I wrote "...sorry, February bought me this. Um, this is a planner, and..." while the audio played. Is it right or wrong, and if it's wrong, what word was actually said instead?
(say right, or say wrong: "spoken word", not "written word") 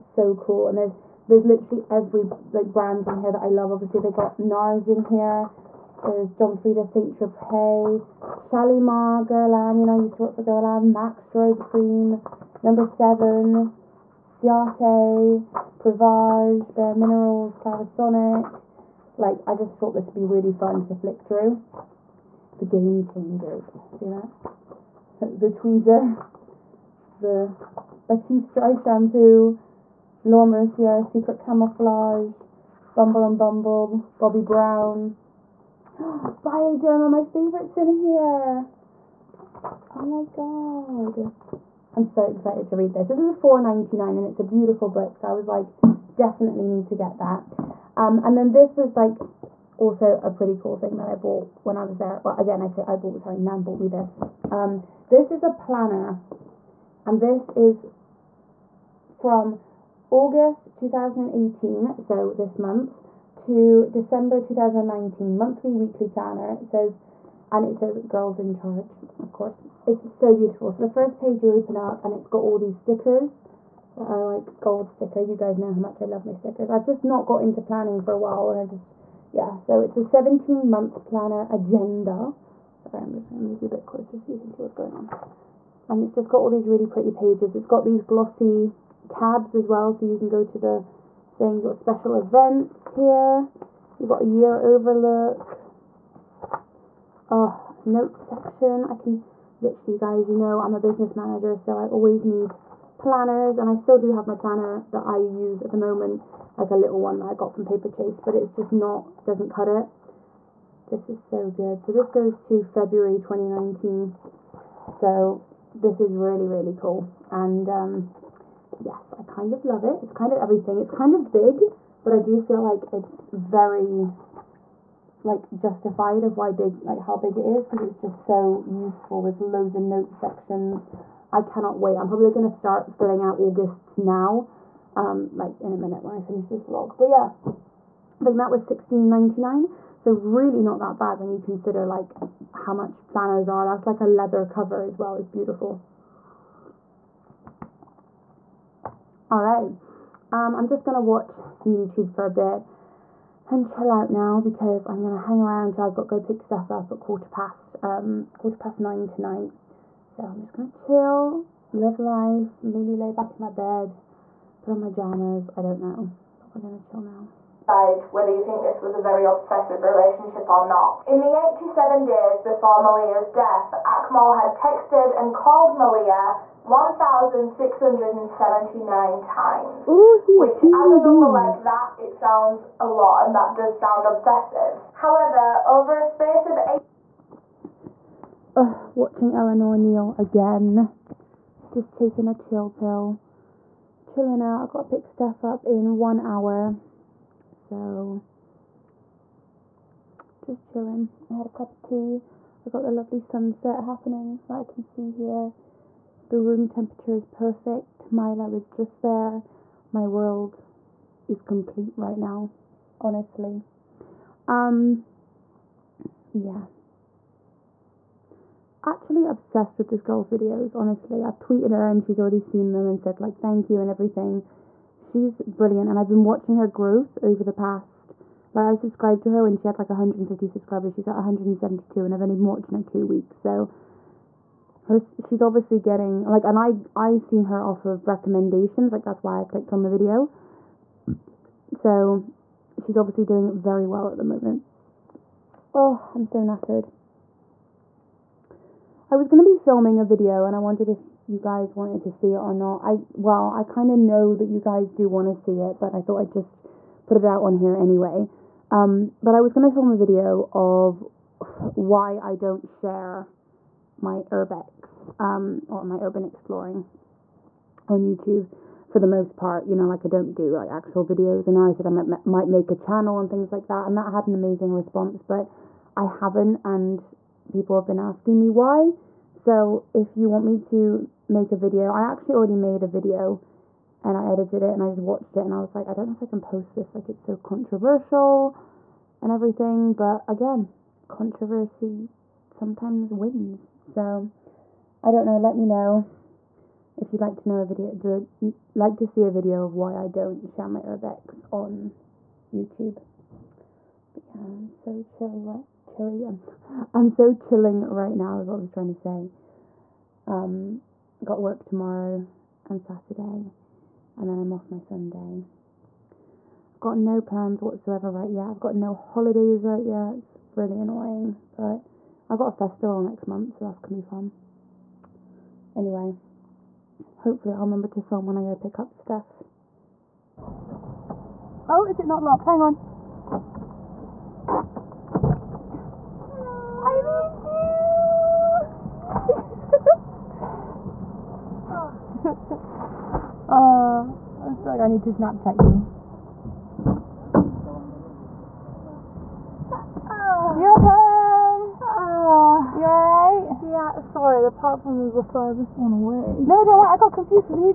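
wrong: "Nan", not "February".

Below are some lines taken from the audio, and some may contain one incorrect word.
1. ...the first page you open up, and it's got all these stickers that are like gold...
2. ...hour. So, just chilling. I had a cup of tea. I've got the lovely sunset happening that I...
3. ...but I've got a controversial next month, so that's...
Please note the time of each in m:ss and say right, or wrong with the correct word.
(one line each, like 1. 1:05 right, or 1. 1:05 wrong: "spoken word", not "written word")
1. 1:10 right
2. 3:16 right
3. 5:21 wrong: "festival", not "controversial".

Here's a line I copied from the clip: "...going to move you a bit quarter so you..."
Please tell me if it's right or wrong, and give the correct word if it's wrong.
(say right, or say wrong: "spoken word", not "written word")
wrong: "closer", not "quarter".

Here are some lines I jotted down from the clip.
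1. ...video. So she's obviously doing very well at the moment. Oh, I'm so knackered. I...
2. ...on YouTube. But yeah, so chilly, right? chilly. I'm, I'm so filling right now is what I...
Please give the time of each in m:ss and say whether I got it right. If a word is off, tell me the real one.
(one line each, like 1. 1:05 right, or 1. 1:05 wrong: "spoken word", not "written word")
1. 3:59 right
2. 5:01 wrong: "chilling", not "filling".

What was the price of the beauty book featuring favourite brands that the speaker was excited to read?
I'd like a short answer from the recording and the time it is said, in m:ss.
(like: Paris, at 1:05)
£4.99, at 0:43.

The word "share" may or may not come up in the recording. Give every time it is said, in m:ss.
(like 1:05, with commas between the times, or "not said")
4:22, 5:00.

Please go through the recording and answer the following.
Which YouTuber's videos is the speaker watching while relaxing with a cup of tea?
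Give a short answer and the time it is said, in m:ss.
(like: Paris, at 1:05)
Eleanor Neale, at 3:09.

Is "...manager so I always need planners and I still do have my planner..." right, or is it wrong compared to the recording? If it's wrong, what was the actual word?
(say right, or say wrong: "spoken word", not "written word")
right.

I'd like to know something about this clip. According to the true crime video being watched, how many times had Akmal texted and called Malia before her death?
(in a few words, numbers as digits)
1,679.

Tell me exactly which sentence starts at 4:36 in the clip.
And people have been asking me why.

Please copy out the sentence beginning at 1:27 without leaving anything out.
It's got these glossy tabs as well so you can go to the thing.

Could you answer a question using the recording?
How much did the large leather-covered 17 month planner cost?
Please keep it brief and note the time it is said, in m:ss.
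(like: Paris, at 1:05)
16.99, at 2:18.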